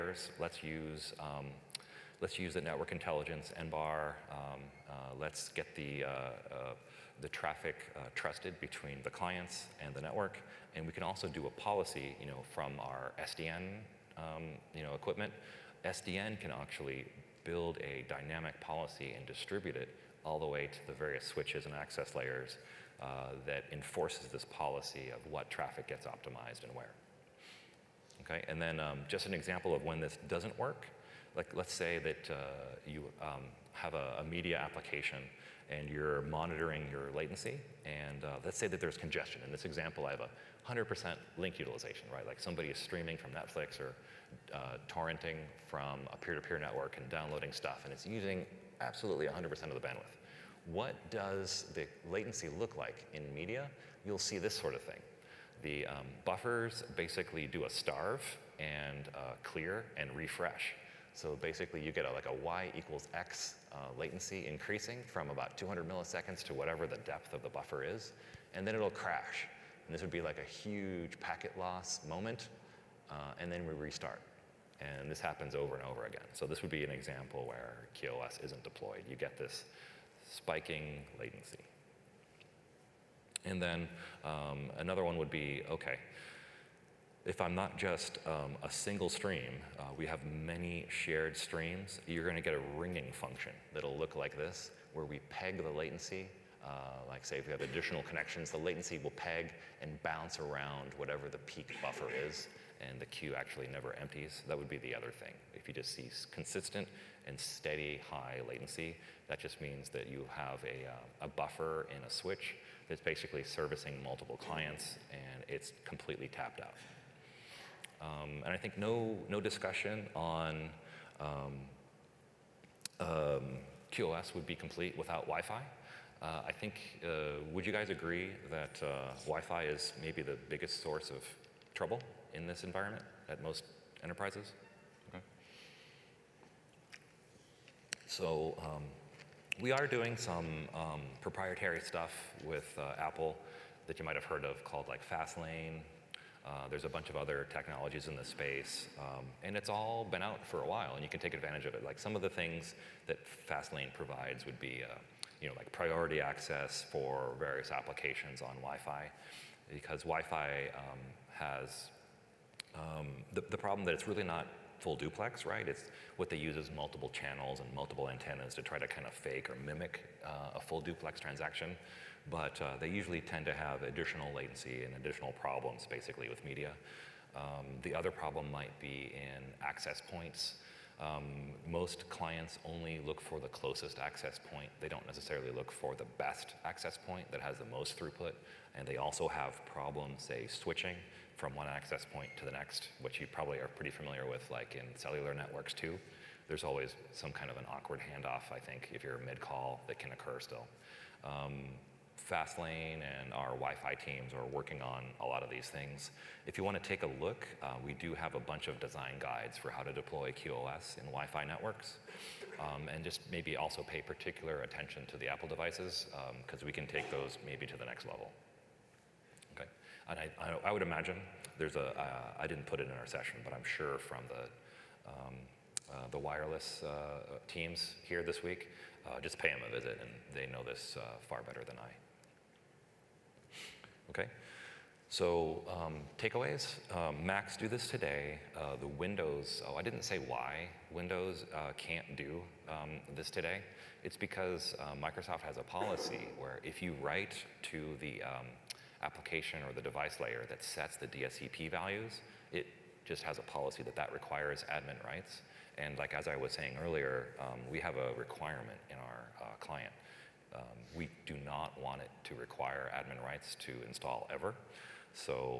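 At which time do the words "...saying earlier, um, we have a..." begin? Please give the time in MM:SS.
04:16.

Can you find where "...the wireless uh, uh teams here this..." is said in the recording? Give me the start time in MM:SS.
03:46.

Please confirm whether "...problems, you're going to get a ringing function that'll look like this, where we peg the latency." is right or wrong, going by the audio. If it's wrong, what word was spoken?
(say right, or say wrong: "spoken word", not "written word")
wrong: "streams", not "problems".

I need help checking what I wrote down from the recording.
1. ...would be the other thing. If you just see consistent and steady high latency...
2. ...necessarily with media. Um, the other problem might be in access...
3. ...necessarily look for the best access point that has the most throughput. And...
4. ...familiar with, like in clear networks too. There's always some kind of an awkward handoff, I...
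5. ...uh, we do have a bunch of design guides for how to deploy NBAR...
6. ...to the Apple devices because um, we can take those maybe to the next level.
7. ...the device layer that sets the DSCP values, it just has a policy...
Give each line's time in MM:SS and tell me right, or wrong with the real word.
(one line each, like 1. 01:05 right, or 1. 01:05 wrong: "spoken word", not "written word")
1. 01:44 right
2. 02:55 wrong: "basically", not "necessarily"
3. 03:05 right
4. 03:13 wrong: "cellular", not "clear"
5. 03:27 wrong: "QoS", not "NBAR"
6. 03:35 right
7. 04:09 right.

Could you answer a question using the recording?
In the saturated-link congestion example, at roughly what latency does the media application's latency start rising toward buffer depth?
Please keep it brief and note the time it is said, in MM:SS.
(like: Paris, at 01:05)
200 milliseconds, at 01:05.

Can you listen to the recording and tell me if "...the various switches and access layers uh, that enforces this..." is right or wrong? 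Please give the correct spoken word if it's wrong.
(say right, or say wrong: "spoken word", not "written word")
right.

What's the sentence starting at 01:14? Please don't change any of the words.
And this happens over and over again.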